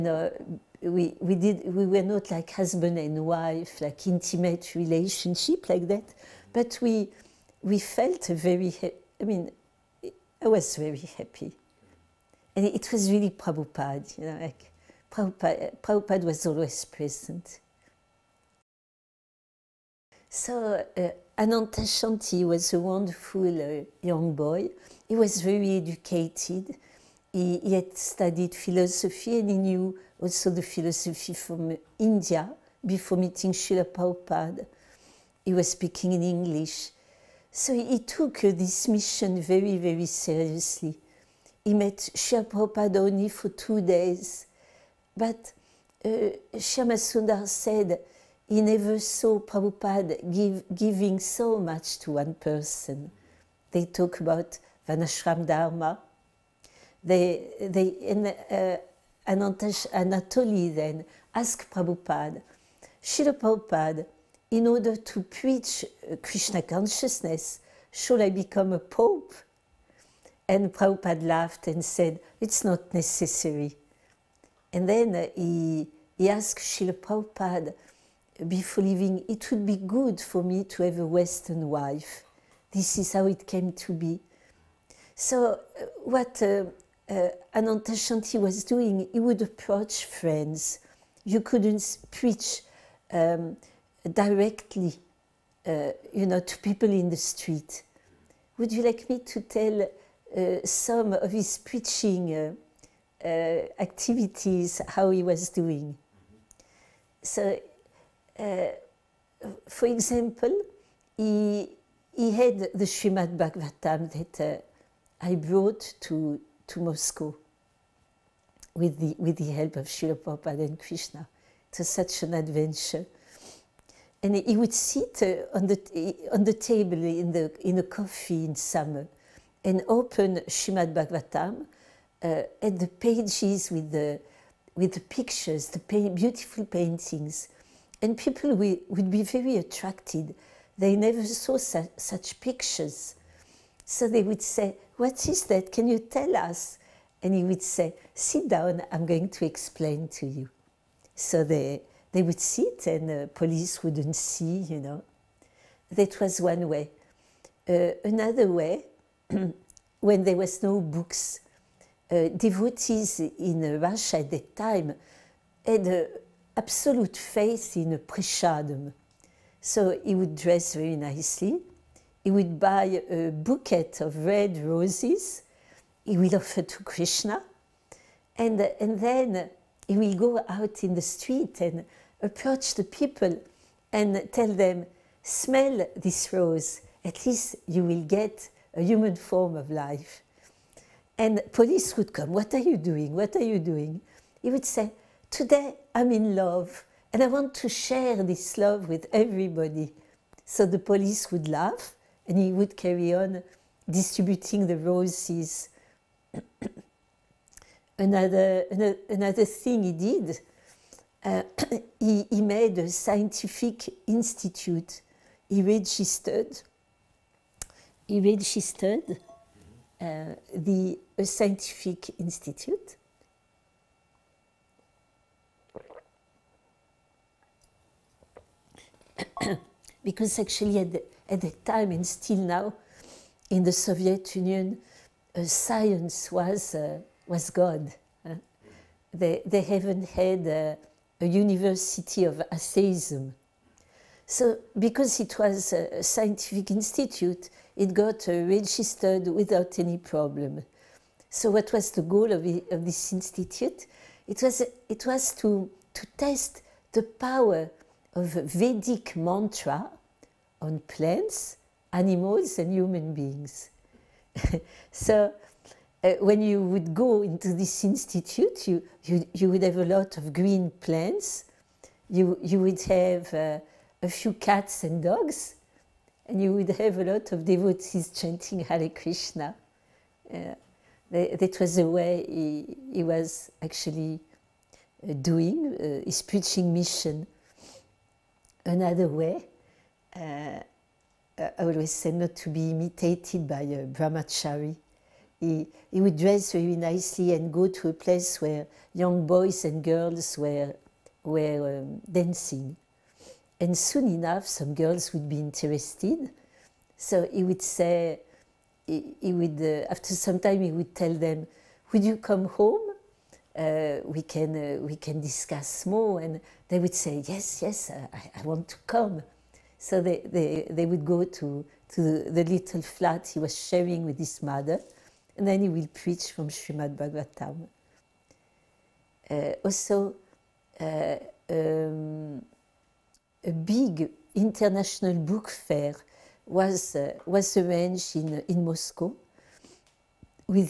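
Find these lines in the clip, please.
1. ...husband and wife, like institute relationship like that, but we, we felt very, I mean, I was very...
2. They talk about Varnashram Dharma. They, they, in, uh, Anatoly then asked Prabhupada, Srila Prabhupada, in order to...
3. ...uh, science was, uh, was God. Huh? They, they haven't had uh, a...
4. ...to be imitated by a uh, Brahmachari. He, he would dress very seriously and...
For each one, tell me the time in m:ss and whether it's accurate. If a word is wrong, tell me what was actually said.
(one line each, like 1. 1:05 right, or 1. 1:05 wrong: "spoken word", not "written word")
1. 0:02 wrong: "intimate", not "institute"
2. 0:53 right
3. 3:55 right
4. 4:52 wrong: "nicely", not "seriously".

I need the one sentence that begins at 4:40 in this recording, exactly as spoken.
Uh, that, was the way he, he was actually uh, doing uh, his preaching mission another way.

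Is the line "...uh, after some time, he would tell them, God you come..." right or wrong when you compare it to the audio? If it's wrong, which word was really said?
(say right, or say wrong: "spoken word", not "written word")
wrong: "Would", not "God".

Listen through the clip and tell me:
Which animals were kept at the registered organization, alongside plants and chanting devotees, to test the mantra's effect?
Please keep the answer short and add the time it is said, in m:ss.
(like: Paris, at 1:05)
Cats and dogs, at 4:34.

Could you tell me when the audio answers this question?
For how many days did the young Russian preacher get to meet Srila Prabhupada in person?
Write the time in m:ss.
0:43.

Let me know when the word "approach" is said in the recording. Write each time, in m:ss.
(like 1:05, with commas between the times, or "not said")
1:29, 3:02.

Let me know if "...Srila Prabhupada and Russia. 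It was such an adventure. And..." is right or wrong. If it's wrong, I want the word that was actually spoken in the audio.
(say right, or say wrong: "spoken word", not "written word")
wrong: "Krishna", not "Russia".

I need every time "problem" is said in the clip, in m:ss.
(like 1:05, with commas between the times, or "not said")
4:09.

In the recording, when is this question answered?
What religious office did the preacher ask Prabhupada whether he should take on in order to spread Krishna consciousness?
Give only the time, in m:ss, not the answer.
1:08.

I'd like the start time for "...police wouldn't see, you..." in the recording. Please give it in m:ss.
2:33.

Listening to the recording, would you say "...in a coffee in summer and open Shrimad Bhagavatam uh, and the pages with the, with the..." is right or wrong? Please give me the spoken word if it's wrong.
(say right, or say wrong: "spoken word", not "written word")
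right.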